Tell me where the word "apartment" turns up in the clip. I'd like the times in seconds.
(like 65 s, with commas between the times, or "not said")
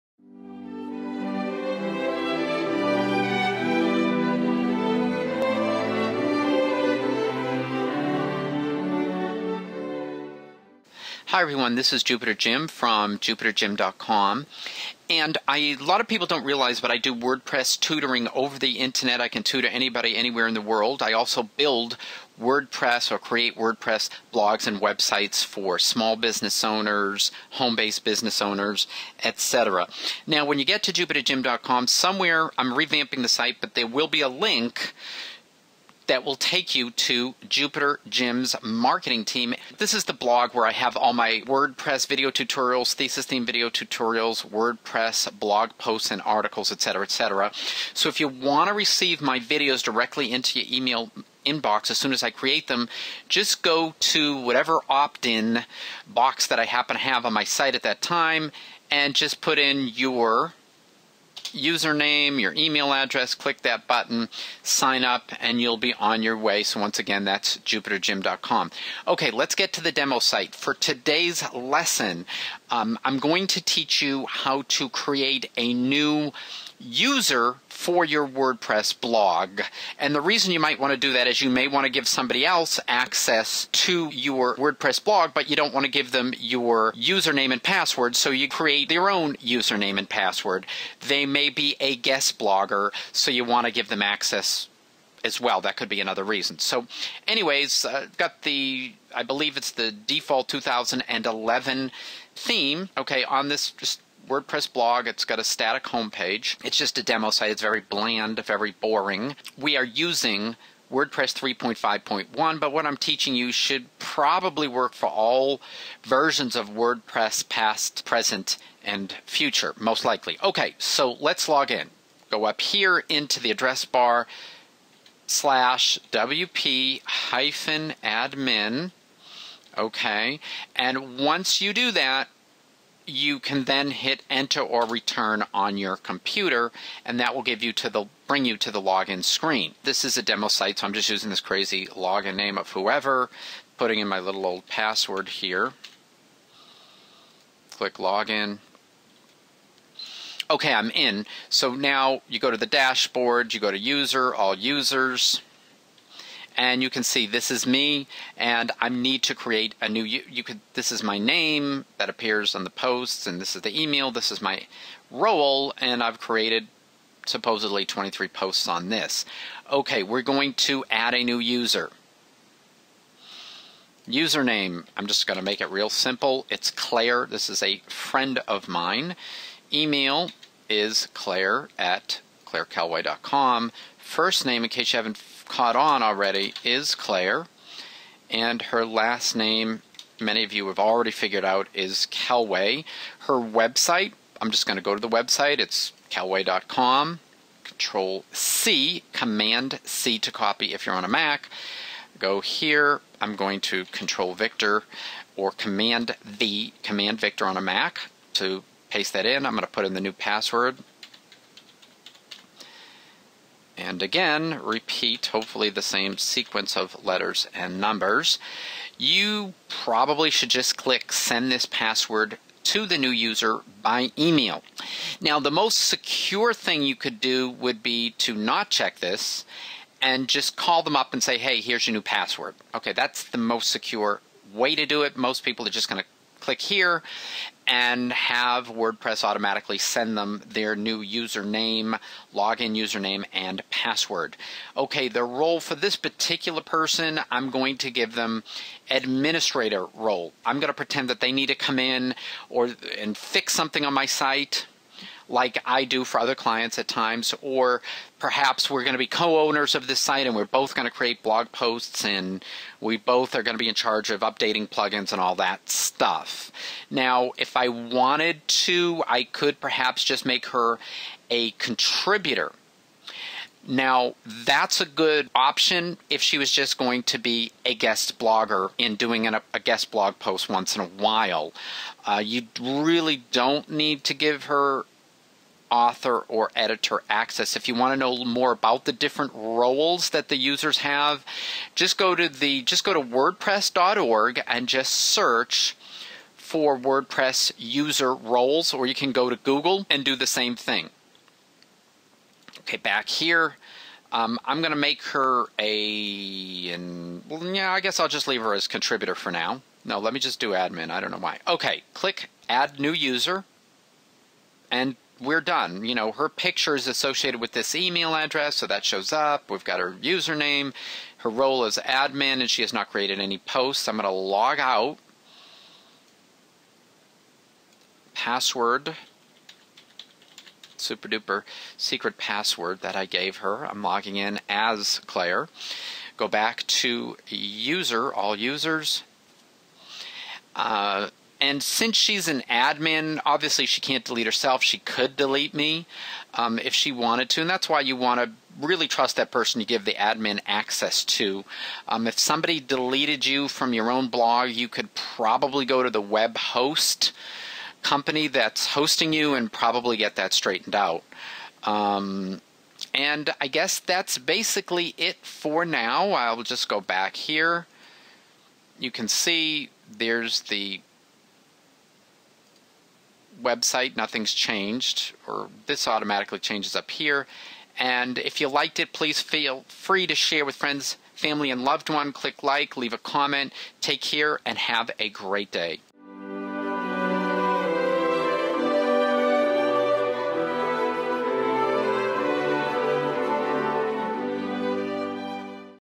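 not said.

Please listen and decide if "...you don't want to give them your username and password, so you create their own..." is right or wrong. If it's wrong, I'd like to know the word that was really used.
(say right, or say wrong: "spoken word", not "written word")
right.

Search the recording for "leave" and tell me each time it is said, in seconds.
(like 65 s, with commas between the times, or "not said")
308 s, 382 s.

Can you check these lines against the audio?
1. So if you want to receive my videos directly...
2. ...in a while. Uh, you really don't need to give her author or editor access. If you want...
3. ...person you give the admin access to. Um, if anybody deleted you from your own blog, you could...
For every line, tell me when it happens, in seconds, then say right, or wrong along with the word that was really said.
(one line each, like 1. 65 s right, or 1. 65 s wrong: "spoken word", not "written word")
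1. 47 s right
2. 280 s right
3. 349 s wrong: "somebody", not "anybody".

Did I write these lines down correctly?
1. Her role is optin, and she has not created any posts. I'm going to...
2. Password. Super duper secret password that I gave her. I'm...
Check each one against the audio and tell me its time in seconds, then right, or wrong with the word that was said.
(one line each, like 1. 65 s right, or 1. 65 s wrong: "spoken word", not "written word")
1. 321 s wrong: "admin", not "optin"
2. 328 s right.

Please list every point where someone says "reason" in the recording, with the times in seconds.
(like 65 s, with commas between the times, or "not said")
80 s, 96 s.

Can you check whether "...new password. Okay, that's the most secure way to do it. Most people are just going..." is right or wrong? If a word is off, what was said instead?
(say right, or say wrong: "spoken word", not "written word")
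right.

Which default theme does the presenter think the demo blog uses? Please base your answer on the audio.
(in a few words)
2011.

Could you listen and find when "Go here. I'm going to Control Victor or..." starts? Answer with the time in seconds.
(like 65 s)
202 s.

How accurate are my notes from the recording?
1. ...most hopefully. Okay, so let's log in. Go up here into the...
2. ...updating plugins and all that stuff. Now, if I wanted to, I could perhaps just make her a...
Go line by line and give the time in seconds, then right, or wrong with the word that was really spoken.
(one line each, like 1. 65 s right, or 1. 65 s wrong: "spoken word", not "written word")
1. 119 s wrong: "likely", not "hopefully"
2. 264 s right.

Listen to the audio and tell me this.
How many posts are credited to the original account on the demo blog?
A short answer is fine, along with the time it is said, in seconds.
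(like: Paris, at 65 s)
23, at 167 s.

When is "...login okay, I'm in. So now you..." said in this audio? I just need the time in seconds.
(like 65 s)
147 s.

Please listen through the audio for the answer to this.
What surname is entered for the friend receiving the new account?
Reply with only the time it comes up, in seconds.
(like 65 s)
192 s.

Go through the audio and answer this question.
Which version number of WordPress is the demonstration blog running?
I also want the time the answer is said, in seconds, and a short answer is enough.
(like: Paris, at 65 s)
3.5.1, at 111 s.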